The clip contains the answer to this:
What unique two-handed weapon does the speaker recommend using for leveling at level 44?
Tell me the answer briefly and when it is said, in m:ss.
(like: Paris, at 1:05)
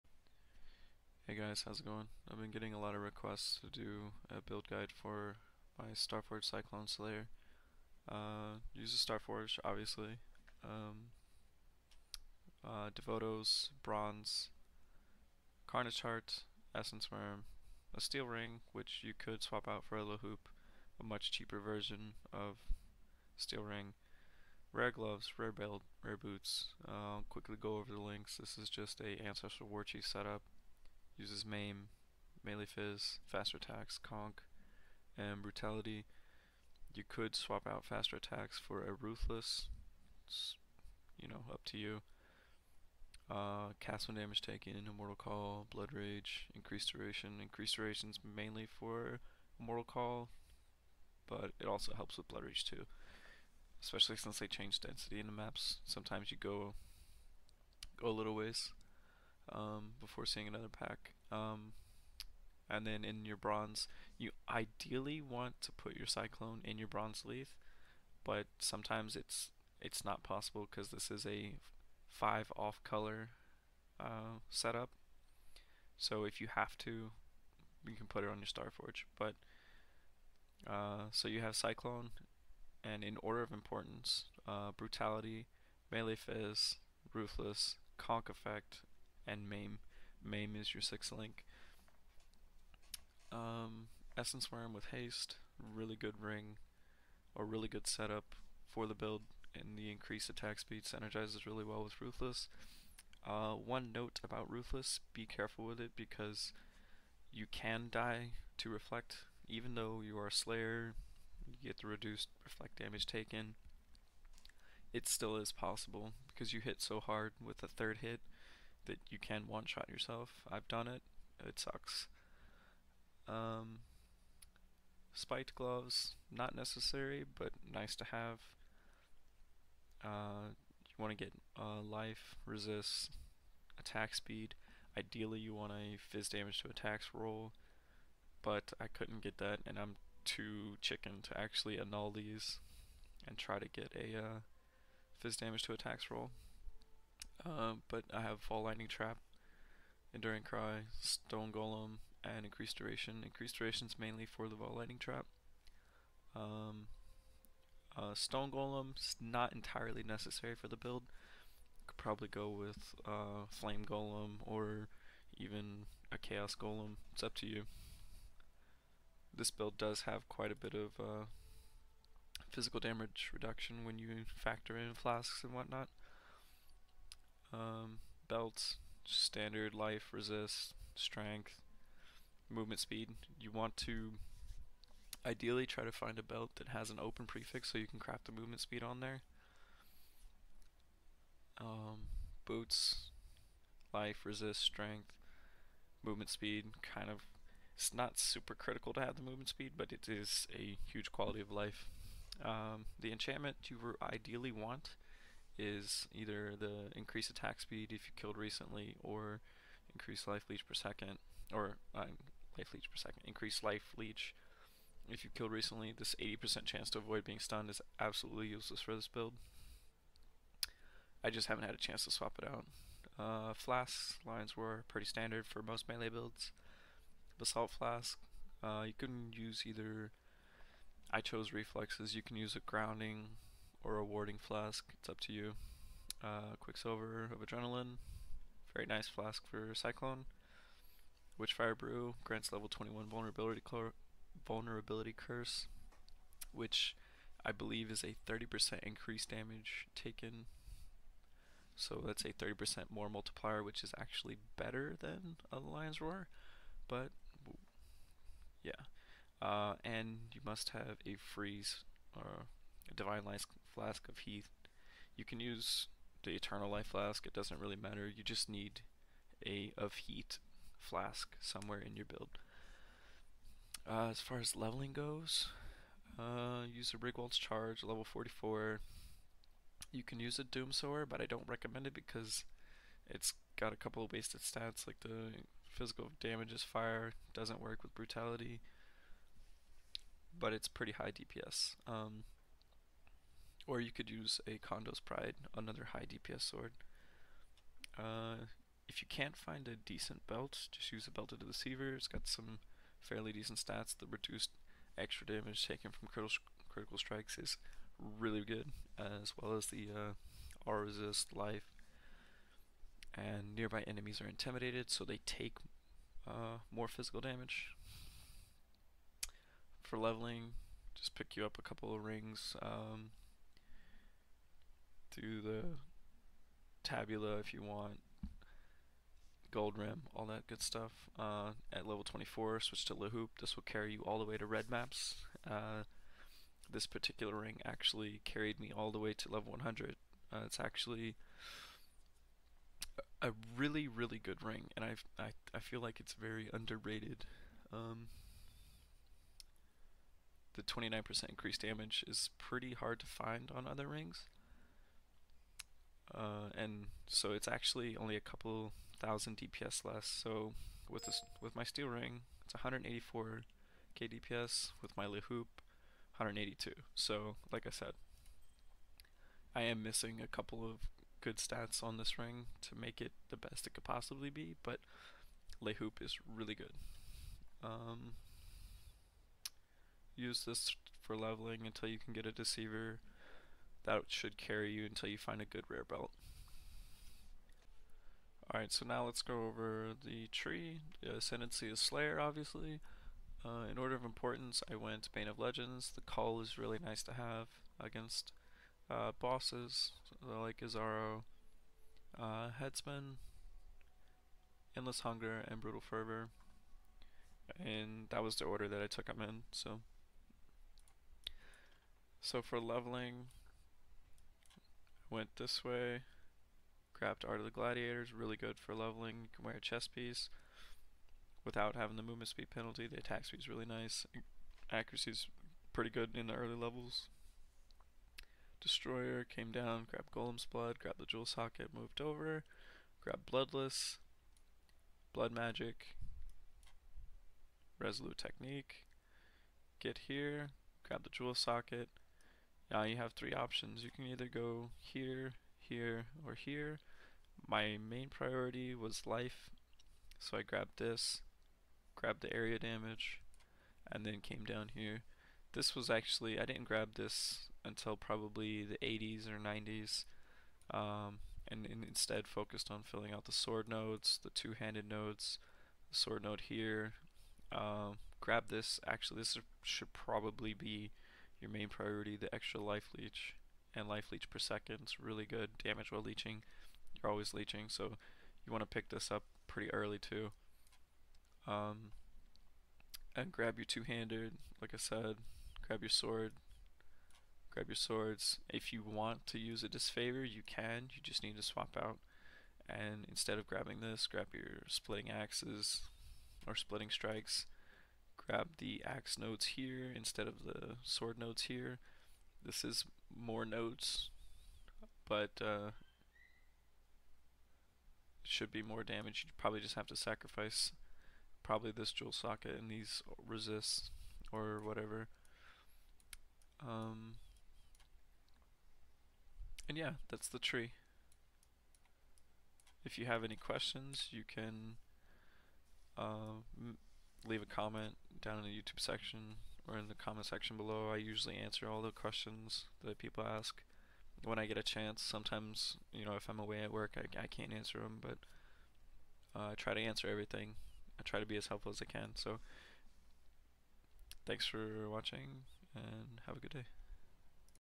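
Rigwald's Charge, at 4:36.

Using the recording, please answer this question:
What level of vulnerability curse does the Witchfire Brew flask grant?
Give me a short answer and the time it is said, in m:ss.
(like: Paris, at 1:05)
21, at 4:02.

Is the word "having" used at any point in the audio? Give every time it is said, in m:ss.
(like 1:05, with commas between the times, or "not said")
7:01.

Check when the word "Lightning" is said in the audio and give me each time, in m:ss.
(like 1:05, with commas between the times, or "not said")
2:28, 2:34.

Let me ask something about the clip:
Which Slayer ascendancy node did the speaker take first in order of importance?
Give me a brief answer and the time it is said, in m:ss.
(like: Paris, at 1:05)
Bane of Legends, at 6:35.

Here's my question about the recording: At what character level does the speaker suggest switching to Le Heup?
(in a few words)
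24.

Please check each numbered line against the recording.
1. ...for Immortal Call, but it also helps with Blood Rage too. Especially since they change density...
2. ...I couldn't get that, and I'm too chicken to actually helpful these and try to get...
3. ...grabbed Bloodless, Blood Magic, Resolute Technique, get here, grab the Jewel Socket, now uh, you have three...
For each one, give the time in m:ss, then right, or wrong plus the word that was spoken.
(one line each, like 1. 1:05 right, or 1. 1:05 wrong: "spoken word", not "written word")
1. 0:48 right
2. 2:18 wrong: "annul", not "helpful"
3. 7:13 right.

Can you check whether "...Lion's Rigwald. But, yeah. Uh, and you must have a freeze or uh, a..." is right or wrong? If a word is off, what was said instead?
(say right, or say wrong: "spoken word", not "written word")
wrong: "Roar", not "Rigwald".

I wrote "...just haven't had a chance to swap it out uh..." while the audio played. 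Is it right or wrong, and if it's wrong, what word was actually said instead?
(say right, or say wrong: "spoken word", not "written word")
right.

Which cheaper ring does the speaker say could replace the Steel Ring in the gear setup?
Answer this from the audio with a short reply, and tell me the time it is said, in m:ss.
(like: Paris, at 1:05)
Hoop, at 0:20.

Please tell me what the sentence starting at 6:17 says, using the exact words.
Um, use this for leveling until you can get a deceiver that should carry you until you find a good rare belt.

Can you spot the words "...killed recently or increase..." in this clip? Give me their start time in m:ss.
3:28.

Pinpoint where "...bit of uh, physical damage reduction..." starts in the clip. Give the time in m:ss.
2:50.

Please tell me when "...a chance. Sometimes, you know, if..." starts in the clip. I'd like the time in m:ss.
8:54.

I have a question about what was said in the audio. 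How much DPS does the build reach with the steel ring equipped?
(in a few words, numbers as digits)
184k.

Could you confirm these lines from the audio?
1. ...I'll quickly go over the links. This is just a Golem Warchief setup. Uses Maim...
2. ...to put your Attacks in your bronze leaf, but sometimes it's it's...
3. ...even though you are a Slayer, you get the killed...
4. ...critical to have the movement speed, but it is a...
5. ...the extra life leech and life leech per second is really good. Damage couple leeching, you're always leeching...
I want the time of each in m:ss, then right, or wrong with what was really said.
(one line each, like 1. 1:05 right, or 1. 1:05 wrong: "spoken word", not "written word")
1. 0:26 wrong: "Ancestral", not "Golem"
2. 1:05 wrong: "Cyclone", not "Attacks"
3. 1:49 wrong: "reduced", not "killed"
4. 3:18 right
5. 7:52 wrong: "while", not "couple".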